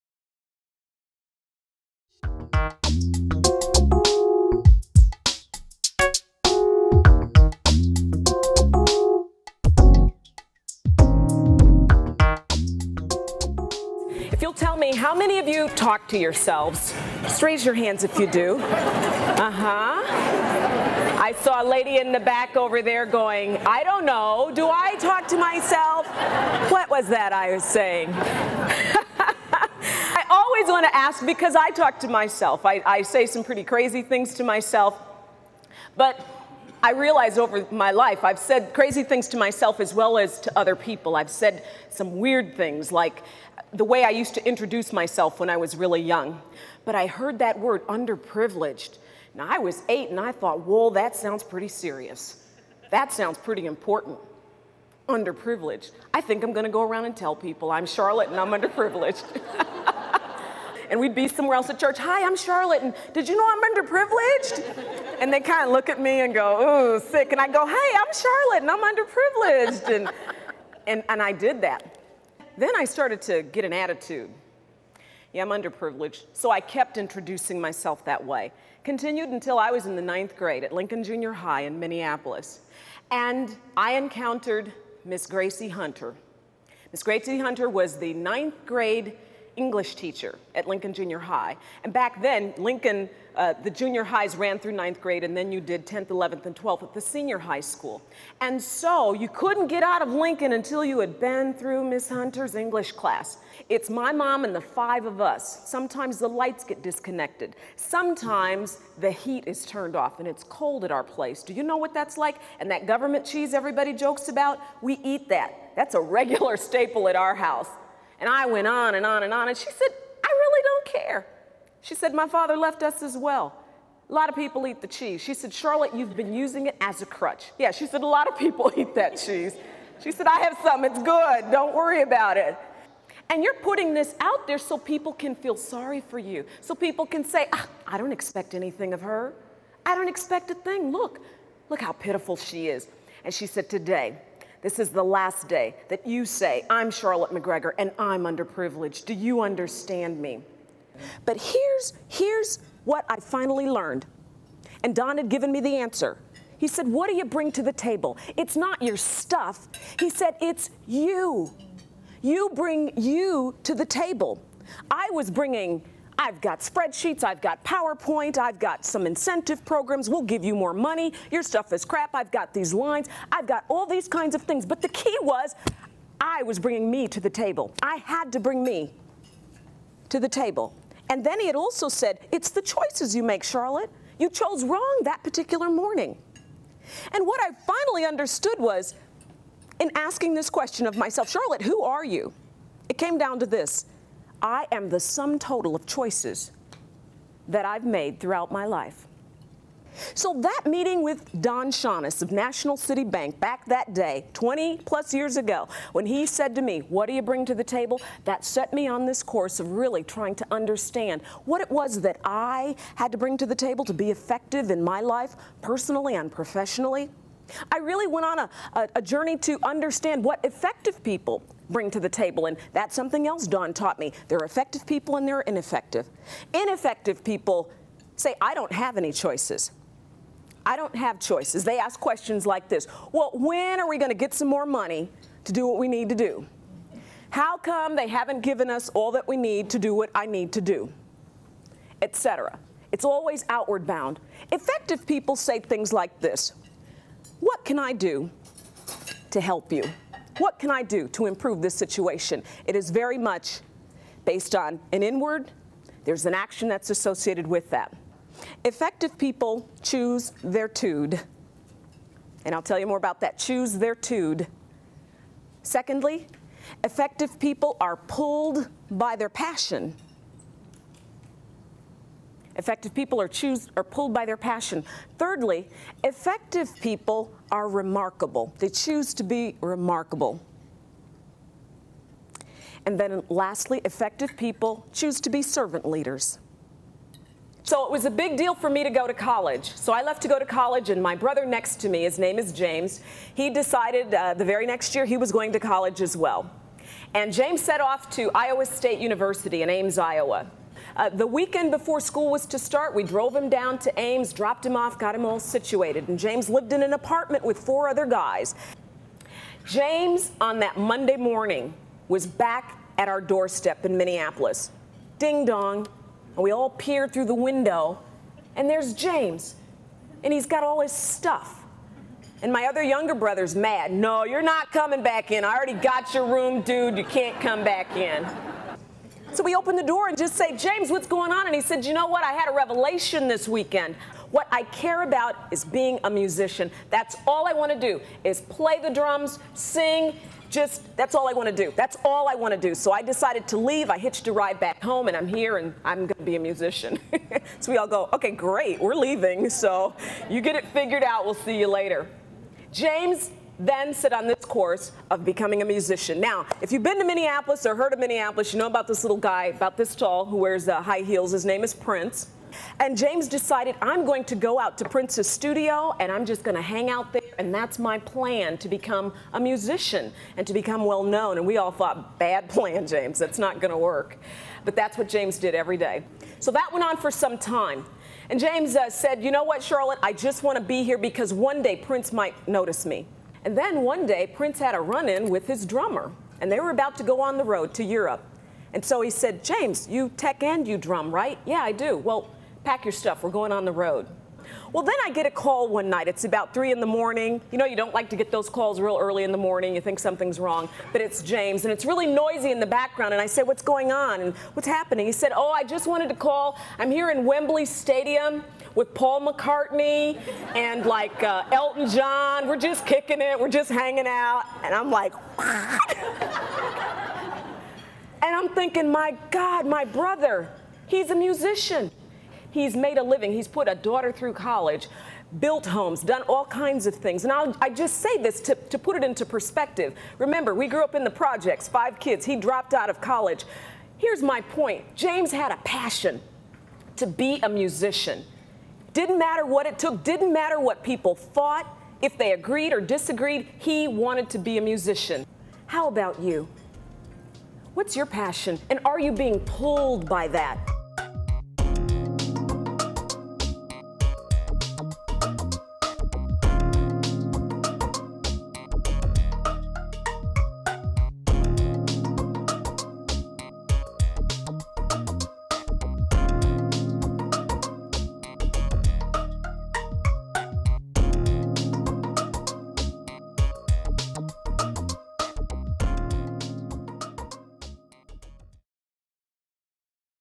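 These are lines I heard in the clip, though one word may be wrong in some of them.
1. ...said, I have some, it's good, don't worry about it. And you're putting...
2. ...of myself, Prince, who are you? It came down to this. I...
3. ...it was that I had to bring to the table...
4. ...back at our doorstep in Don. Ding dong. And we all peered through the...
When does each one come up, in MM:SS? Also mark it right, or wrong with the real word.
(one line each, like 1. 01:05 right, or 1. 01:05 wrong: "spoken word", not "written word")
1. 02:10 right
2. 03:10 wrong: "Charlotte", not "Prince"
3. 03:31 right
4. 05:12 wrong: "Minneapolis", not "Don".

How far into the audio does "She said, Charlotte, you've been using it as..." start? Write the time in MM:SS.
02:05.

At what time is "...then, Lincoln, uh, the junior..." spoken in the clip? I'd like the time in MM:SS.
01:32.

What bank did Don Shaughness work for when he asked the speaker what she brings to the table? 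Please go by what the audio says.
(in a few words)
National City Bank.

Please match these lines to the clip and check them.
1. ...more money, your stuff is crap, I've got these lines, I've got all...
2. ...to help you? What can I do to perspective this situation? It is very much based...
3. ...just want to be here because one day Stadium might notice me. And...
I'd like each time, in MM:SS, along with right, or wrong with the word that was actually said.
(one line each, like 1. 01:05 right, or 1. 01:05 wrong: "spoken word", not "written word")
1. 02:50 right
2. 04:09 wrong: "improve", not "perspective"
3. 06:20 wrong: "Prince", not "Stadium".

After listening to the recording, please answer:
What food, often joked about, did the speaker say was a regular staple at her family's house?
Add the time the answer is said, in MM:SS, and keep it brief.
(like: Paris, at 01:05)
Government cheese, at 01:52.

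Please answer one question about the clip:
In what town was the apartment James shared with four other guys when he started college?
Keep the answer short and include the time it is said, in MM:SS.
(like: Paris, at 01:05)
Ames, Iowa, at 04:59.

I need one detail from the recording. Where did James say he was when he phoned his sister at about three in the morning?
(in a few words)
Wembley Stadium.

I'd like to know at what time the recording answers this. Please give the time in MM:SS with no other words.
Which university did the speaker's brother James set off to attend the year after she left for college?
04:58.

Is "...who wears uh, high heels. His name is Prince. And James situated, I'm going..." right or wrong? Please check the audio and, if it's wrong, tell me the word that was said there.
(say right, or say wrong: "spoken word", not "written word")
wrong: "decided", not "situated".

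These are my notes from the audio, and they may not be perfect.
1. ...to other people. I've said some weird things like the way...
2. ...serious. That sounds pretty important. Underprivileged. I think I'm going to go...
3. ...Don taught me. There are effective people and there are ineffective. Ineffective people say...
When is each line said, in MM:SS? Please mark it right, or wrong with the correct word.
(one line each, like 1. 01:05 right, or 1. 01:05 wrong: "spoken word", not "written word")
1. 00:40 right
2. 00:51 right
3. 03:43 right.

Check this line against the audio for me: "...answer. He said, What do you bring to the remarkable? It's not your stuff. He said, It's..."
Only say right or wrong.
wrong.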